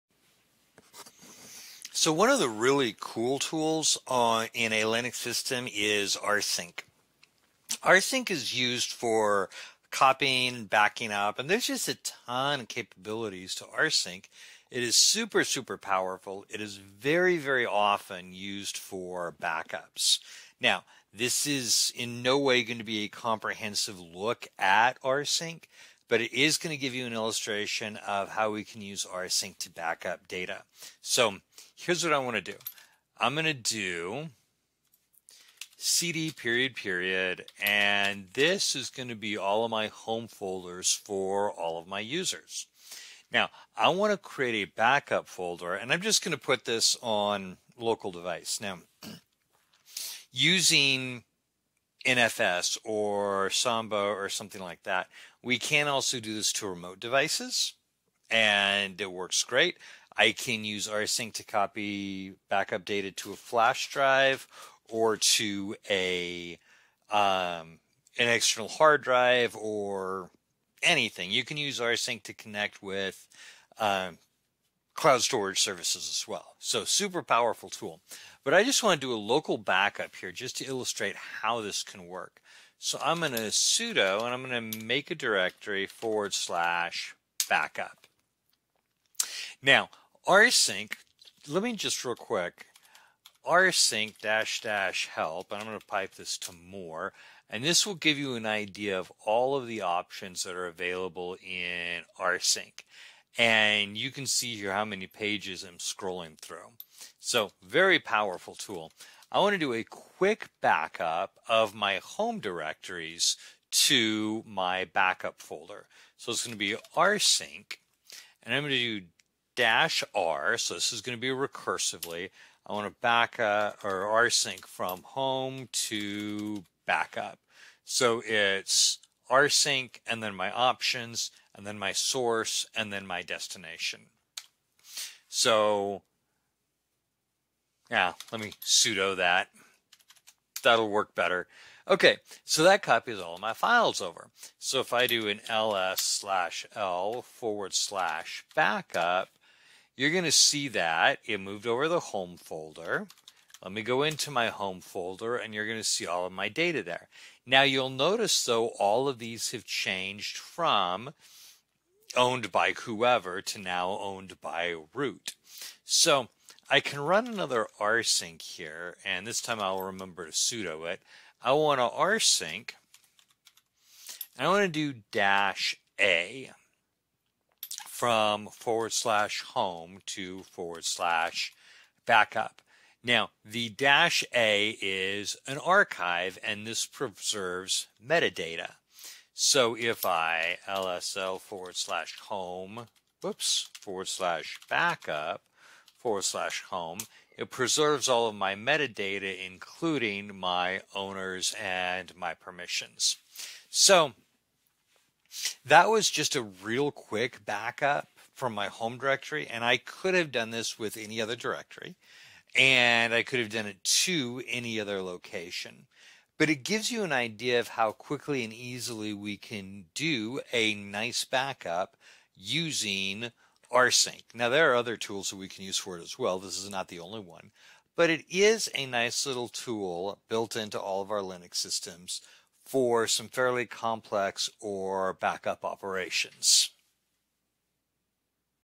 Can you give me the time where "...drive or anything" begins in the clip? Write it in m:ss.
1:09.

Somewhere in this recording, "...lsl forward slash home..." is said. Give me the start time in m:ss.
3:10.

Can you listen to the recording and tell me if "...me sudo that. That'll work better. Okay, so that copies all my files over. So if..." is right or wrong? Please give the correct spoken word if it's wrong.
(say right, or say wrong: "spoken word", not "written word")
right.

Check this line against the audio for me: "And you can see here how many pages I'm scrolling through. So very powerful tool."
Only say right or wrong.
right.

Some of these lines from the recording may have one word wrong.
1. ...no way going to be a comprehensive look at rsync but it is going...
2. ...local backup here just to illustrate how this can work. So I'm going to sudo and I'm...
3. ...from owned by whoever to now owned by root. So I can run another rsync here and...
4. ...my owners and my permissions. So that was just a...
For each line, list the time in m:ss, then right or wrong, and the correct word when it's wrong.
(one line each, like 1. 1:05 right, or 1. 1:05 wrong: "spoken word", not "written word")
1. 0:22 right
2. 1:19 right
3. 2:40 right
4. 3:20 right.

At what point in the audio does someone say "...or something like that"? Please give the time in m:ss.
0:53.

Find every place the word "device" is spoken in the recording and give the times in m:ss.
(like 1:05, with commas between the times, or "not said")
0:48, 0:56.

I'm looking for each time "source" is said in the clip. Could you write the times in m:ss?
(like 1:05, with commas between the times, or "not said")
2:11.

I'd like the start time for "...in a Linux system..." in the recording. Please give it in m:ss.
0:04.